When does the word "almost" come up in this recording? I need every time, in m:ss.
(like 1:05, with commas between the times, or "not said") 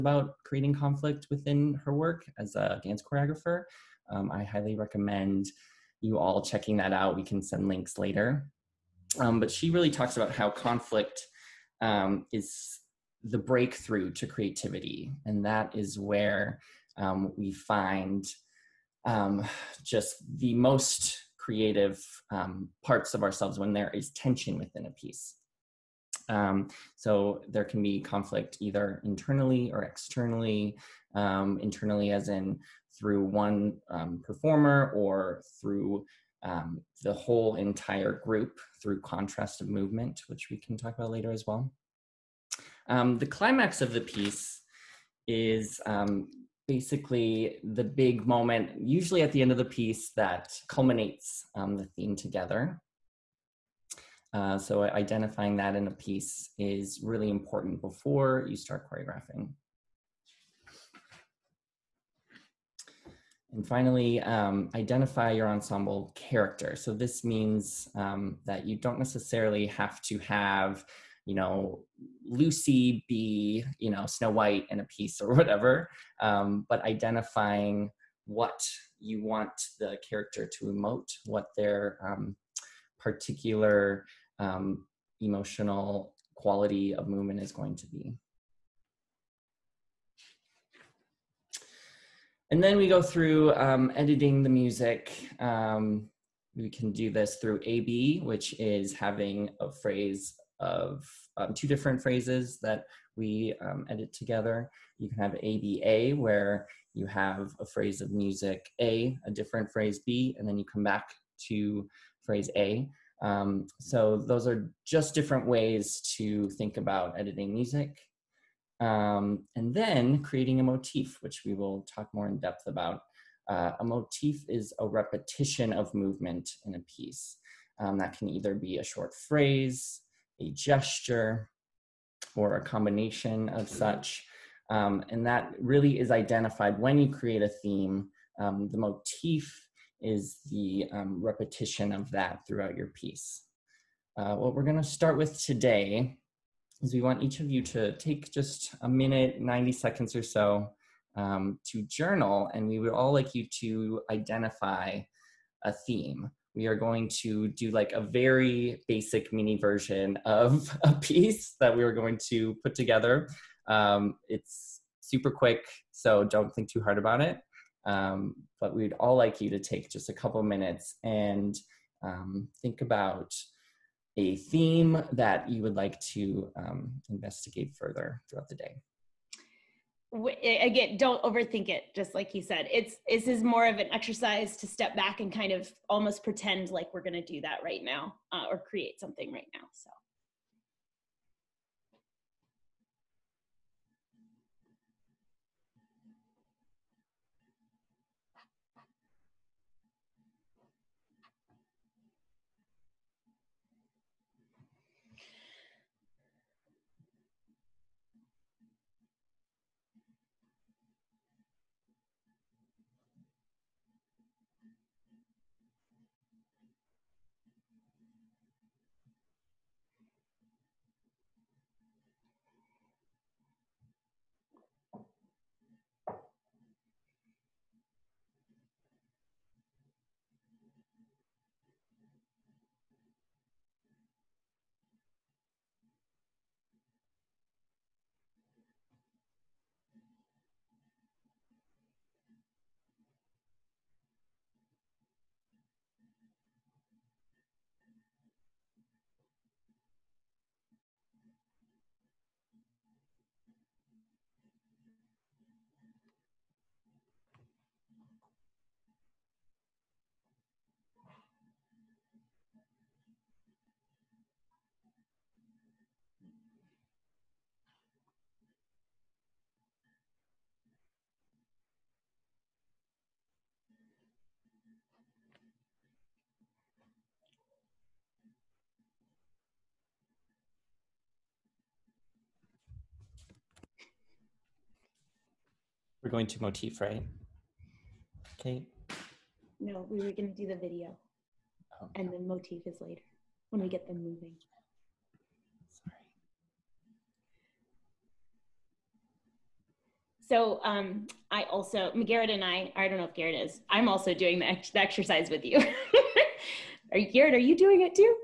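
3:05.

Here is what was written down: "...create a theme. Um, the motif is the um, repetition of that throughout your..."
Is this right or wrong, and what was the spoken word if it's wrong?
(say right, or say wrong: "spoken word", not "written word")
right.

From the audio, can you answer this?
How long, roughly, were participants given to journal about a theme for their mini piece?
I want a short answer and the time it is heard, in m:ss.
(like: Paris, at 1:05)
90 seconds, at 2:29.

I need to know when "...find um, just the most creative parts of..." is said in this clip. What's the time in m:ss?
0:17.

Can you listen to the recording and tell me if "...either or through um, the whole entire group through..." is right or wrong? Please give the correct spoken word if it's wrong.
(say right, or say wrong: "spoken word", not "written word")
wrong: "performer", not "either".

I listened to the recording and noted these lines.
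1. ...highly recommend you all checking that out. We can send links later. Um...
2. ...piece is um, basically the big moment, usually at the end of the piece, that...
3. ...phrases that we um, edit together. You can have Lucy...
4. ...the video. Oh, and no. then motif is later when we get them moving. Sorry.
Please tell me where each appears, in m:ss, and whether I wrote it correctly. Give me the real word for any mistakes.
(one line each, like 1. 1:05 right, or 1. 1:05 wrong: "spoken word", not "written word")
1. 0:04 right
2. 0:43 right
3. 1:42 wrong: "ABA", not "Lucy"
4. 4:50 right.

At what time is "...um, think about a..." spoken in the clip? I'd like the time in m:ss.
2:52.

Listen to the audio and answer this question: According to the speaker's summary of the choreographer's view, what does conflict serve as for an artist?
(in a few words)
breakthrough to creativity.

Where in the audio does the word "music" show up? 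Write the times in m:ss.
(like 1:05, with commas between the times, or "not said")
1:34, 1:48, 1:57.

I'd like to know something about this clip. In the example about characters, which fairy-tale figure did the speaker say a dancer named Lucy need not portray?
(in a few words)
Snow White.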